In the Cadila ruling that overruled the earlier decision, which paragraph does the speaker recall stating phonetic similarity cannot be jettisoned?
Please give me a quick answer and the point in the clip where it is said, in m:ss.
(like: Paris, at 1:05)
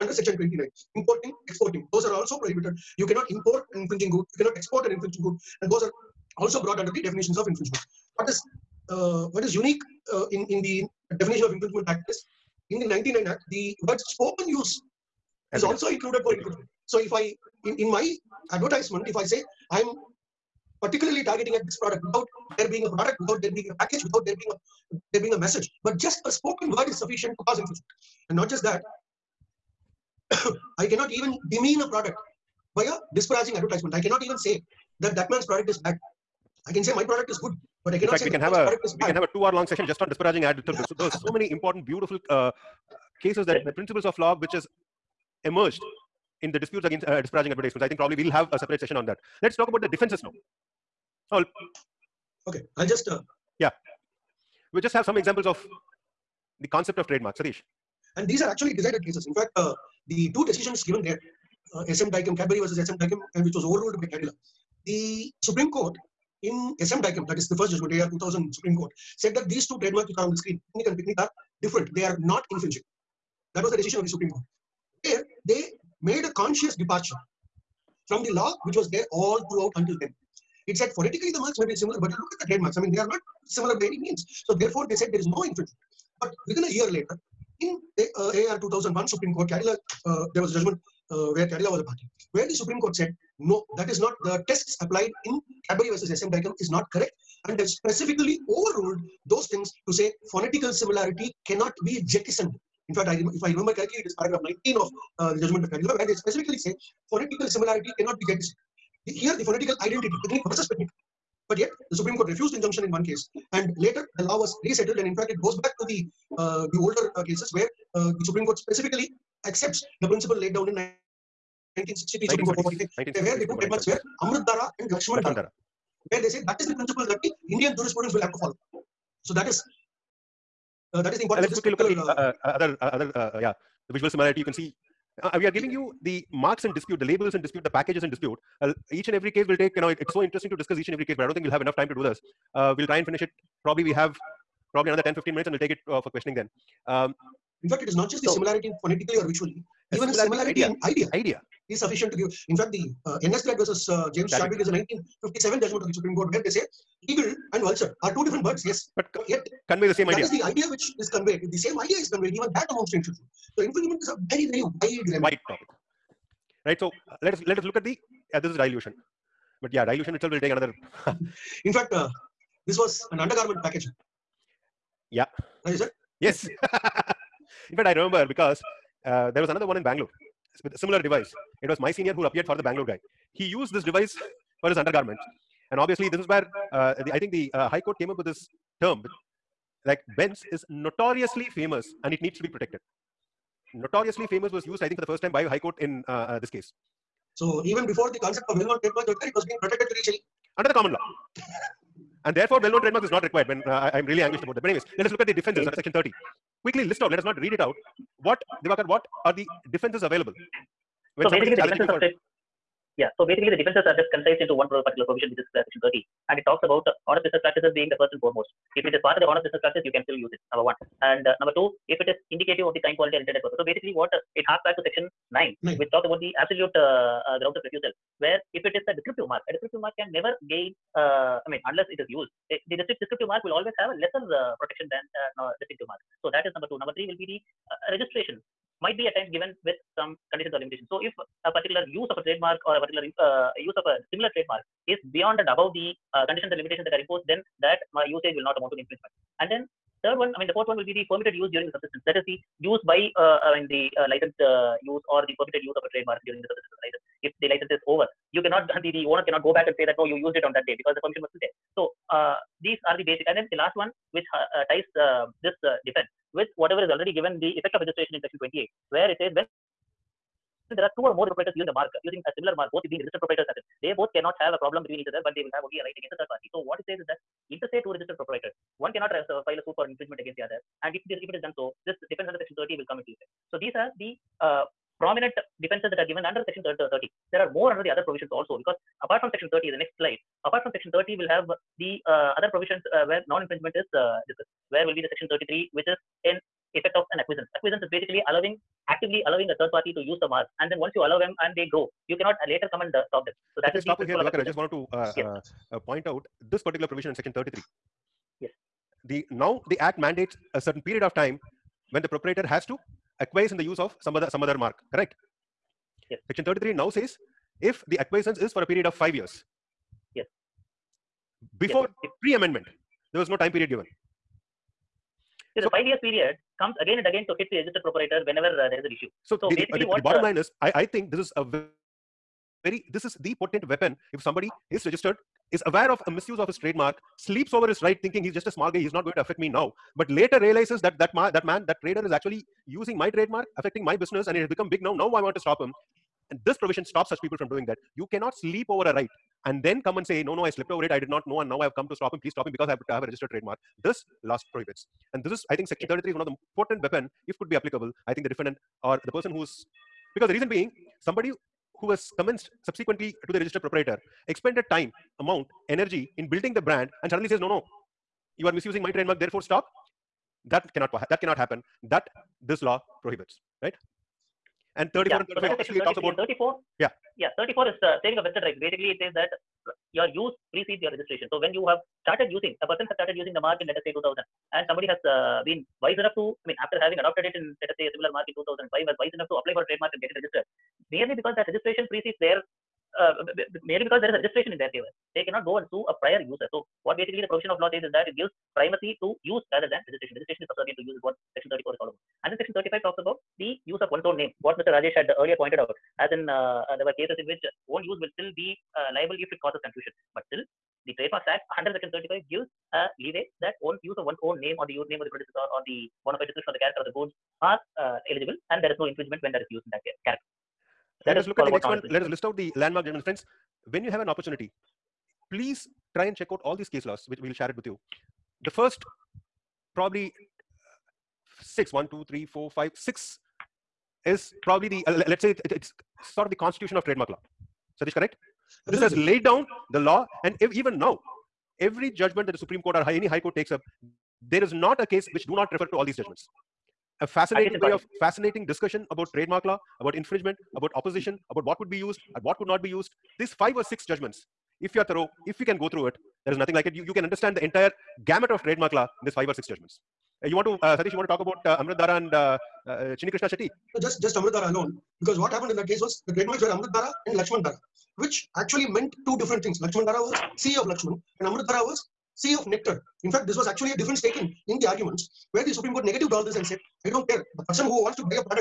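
Paragraph 19, at 1:44.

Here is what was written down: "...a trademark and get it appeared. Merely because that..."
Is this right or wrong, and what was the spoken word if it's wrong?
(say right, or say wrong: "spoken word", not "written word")
wrong: "registered", not "appeared".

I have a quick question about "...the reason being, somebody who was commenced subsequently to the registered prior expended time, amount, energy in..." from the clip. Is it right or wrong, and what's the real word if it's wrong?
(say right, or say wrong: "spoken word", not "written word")
wrong: "proprietor", not "prior".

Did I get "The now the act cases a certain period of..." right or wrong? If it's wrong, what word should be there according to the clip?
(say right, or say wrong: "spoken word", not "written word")
wrong: "mandates", not "cases".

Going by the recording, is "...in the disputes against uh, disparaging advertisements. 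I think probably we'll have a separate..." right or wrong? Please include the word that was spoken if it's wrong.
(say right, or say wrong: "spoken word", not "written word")
right.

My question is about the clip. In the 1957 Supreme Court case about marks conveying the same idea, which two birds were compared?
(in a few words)
Eagle and vulture.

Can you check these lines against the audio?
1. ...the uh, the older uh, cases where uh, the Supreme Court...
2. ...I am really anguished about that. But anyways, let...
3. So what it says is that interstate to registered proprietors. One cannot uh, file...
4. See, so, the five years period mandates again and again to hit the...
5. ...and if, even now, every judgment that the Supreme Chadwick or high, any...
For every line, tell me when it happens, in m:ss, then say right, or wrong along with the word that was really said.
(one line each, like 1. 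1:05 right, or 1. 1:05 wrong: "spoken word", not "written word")
1. 1:55 right
2. 3:23 right
3. 4:36 right
4. 5:25 wrong: "comes", not "mandates"
5. 7:20 wrong: "Court", not "Chadwick".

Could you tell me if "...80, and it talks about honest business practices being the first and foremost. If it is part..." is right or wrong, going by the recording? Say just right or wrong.
wrong.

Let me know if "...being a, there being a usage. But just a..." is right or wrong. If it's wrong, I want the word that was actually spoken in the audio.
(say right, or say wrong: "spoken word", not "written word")
wrong: "message", not "usage".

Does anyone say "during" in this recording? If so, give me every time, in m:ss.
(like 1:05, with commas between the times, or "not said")
4:11, 4:16.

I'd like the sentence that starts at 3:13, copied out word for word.
Notoriously famous was used, I think, for the first time by High Court in uh, uh, this case.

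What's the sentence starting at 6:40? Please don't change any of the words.
Registration is subservient to use is what section 34 is all about.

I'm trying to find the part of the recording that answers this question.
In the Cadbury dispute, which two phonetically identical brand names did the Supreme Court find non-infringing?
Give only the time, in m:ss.
1:10.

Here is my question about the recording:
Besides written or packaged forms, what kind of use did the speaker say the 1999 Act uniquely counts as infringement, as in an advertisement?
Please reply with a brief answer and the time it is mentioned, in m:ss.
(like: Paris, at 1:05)
Spoken use, at 0:13.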